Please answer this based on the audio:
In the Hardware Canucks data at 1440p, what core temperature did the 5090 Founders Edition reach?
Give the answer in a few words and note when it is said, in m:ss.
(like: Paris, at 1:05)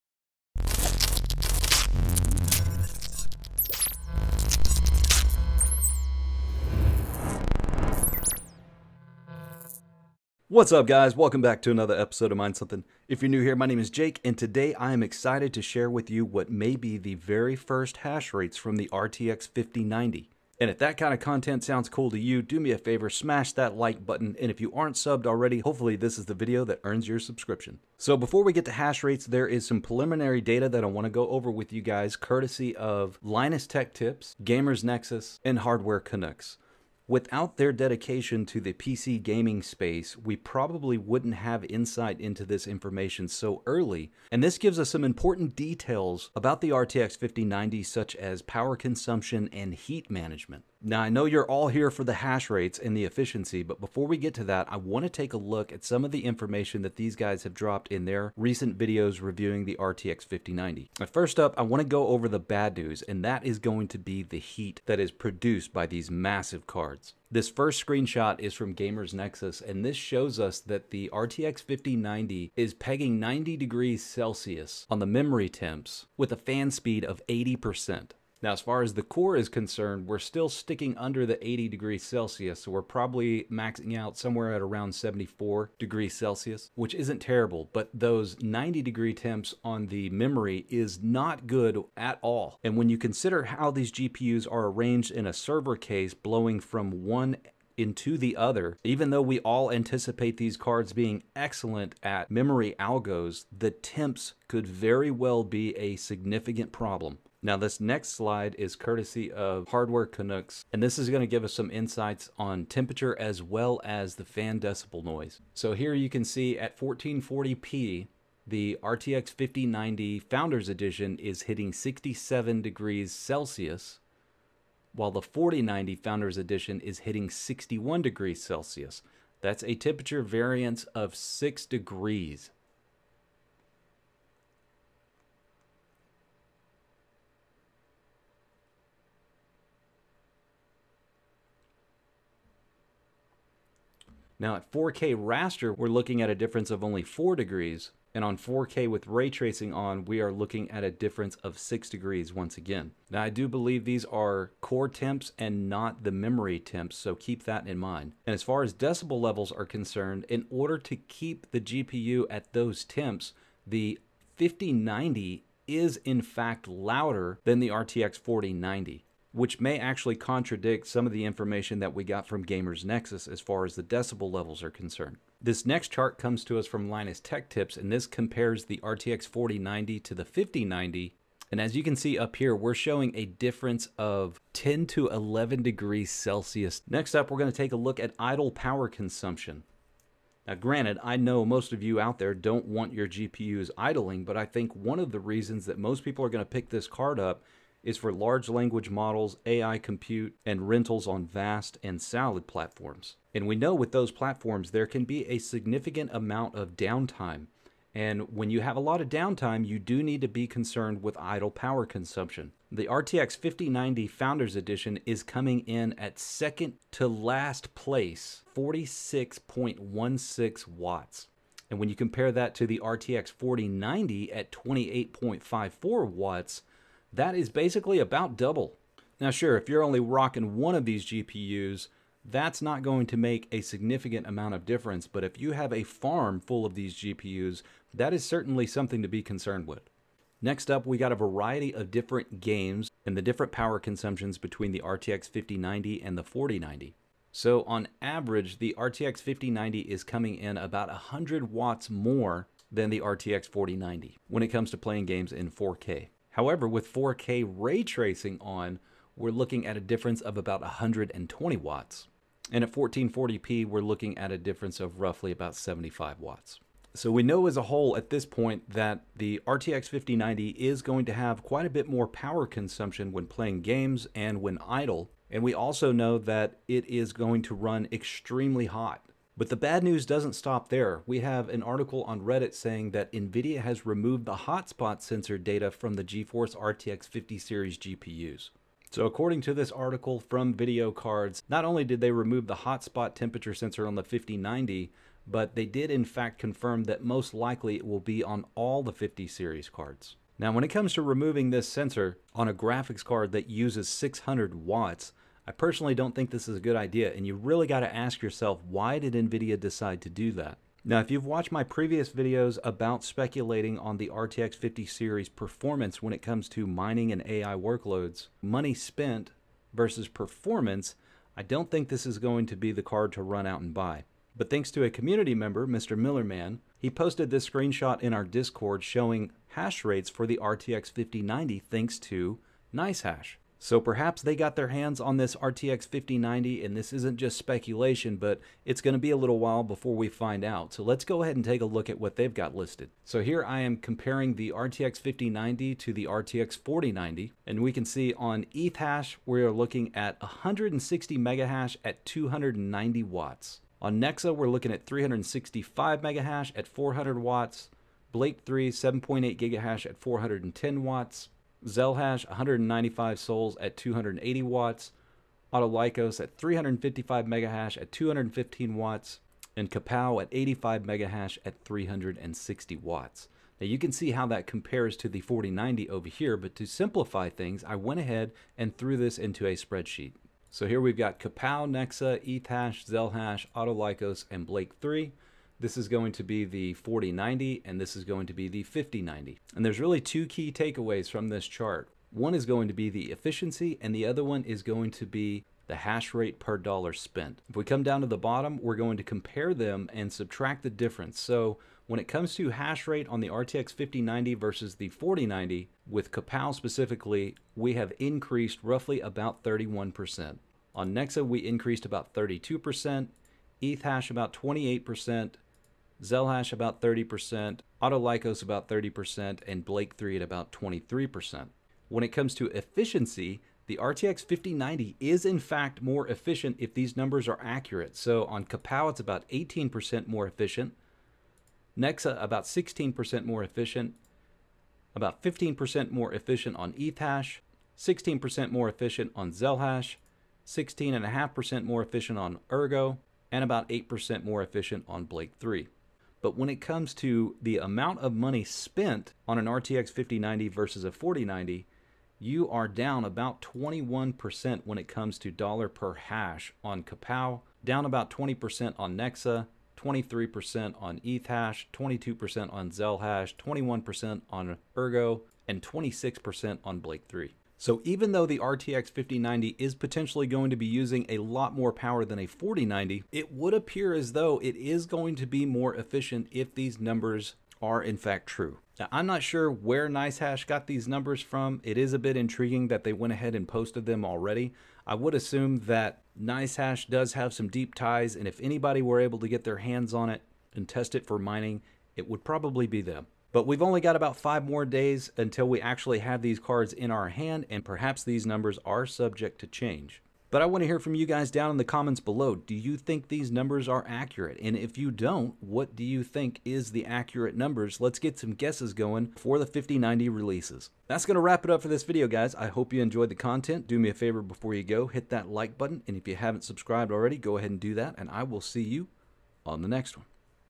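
67 degrees Celsius, at 2:01.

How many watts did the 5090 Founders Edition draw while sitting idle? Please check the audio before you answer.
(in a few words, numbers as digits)
46.16 watts.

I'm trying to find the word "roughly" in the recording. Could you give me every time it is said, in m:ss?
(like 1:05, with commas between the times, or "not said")
4:24, 6:48.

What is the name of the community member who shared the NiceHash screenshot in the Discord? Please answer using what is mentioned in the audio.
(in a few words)
Mr. Millerman.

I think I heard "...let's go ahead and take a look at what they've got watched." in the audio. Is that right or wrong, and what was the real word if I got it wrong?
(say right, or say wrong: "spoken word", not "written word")
wrong: "listed", not "watched".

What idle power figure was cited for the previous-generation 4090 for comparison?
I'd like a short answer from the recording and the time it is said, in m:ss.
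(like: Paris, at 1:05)
28.54 watts, at 3:44.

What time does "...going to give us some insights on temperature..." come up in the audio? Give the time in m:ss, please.
1:51.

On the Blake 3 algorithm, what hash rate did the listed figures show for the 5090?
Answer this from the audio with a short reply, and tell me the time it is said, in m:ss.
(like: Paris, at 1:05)
7.8 gigahash, at 5:58.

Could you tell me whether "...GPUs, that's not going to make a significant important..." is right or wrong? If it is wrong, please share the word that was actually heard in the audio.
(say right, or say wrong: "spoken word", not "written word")
wrong: "amount", not "important".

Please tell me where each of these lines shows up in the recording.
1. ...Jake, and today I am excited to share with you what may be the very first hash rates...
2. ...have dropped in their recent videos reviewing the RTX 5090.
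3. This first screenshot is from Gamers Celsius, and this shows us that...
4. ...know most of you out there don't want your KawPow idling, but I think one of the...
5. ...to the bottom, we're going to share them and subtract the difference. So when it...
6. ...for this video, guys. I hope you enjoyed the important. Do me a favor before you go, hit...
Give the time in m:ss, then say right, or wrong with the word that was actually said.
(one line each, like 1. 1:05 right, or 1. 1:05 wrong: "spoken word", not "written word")
1. 0:13 right
2. 0:57 right
3. 1:07 wrong: "Nexus", not "Celsius"
4. 3:11 wrong: "GPUs", not "KawPow"
5. 6:38 wrong: "compare", not "share"
6. 8:31 wrong: "content", not "important".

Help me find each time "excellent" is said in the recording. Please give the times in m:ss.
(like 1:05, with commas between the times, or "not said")
1:41.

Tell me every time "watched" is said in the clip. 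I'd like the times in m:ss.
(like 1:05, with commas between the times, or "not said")
5:11.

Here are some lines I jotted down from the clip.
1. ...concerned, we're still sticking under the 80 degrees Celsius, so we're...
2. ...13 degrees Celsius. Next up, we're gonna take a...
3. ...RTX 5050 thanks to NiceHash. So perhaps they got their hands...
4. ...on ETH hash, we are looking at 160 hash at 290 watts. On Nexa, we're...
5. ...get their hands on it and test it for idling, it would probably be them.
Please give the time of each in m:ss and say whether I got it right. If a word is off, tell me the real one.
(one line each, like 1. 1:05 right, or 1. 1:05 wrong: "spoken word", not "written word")
1. 1:19 right
2. 3:05 wrong: "11", not "13"
3. 5:30 wrong: "5090", not "5050"
4. 5:48 right
5. 8:09 wrong: "mining", not "idling".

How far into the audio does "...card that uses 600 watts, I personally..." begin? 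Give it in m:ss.
5:03.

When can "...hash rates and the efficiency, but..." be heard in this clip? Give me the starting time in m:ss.
0:52.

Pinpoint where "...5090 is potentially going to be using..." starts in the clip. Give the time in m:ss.
7:48.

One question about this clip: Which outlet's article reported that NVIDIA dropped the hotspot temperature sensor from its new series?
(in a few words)
VideoCardz.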